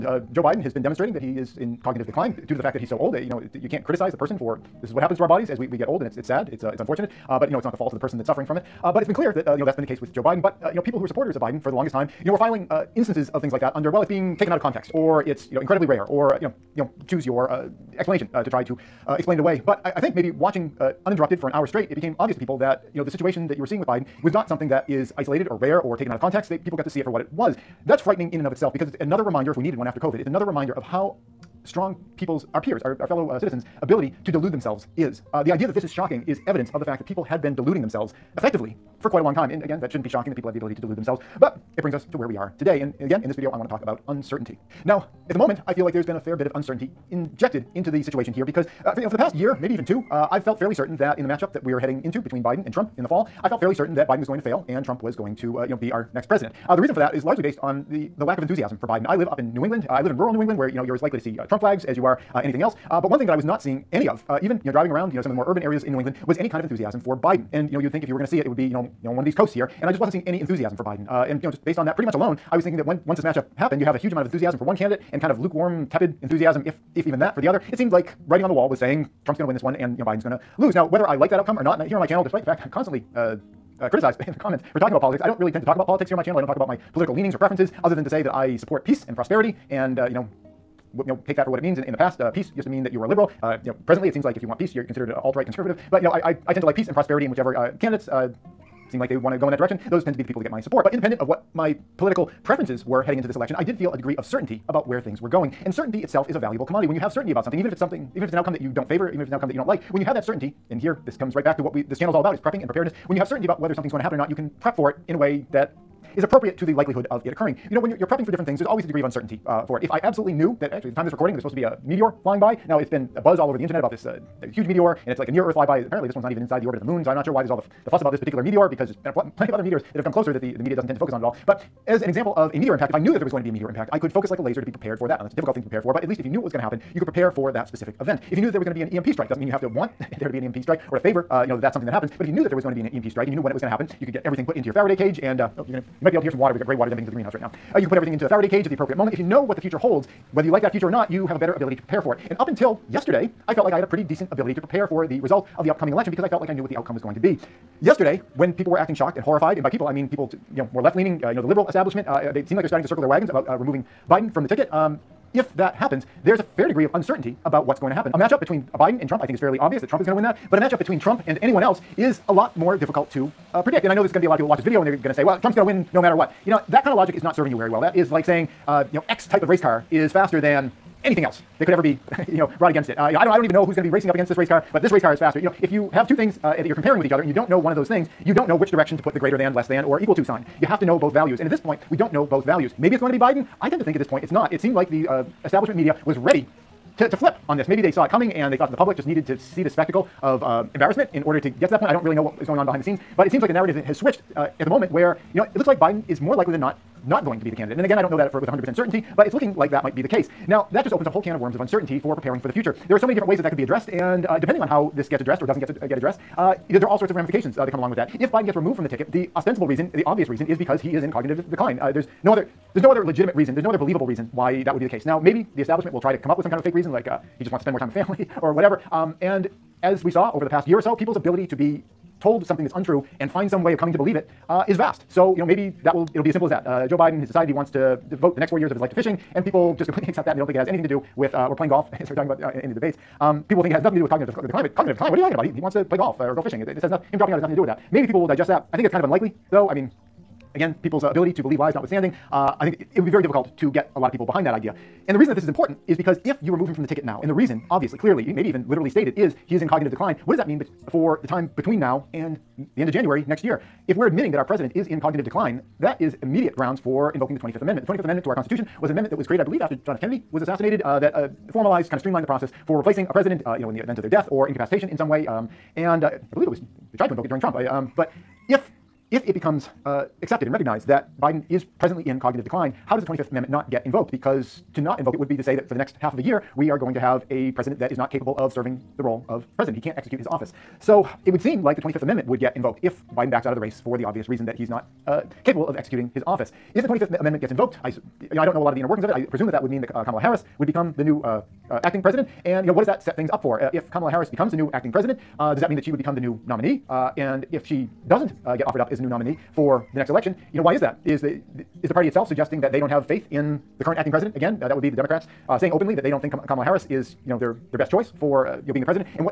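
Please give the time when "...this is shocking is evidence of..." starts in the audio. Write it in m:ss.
0:35.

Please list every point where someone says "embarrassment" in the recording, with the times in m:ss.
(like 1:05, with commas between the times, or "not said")
3:20.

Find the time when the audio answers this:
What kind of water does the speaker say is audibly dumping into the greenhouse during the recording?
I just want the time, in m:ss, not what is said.
2:26.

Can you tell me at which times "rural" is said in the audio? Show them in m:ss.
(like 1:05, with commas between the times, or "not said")
1:00.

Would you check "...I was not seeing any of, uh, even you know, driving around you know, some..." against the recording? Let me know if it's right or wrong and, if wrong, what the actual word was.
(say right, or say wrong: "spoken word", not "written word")
right.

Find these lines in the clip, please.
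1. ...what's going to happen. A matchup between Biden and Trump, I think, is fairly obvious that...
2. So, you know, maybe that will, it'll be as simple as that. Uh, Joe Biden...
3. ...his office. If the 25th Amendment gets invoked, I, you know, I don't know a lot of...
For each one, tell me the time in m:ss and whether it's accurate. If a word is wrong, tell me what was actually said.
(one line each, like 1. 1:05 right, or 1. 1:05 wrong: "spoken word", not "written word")
1. 2:47 right
2. 3:55 right
3. 4:56 right.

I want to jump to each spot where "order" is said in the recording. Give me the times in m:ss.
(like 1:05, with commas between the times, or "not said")
3:21.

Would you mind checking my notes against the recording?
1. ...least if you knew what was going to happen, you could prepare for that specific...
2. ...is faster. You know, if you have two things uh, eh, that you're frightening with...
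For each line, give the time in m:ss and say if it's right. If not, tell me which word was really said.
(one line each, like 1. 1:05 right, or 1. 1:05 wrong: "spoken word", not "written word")
1. 2:16 right
2. 3:05 wrong: "comparing", not "frightening".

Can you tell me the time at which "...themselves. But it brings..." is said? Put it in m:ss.
0:40.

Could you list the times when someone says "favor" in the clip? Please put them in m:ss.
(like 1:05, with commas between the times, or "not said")
1:48, 2:20.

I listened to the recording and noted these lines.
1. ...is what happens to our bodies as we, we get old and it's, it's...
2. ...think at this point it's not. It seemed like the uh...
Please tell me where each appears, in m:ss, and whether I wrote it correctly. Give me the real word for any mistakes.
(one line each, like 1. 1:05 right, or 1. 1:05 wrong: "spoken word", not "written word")
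1. 0:04 right
2. 3:13 right.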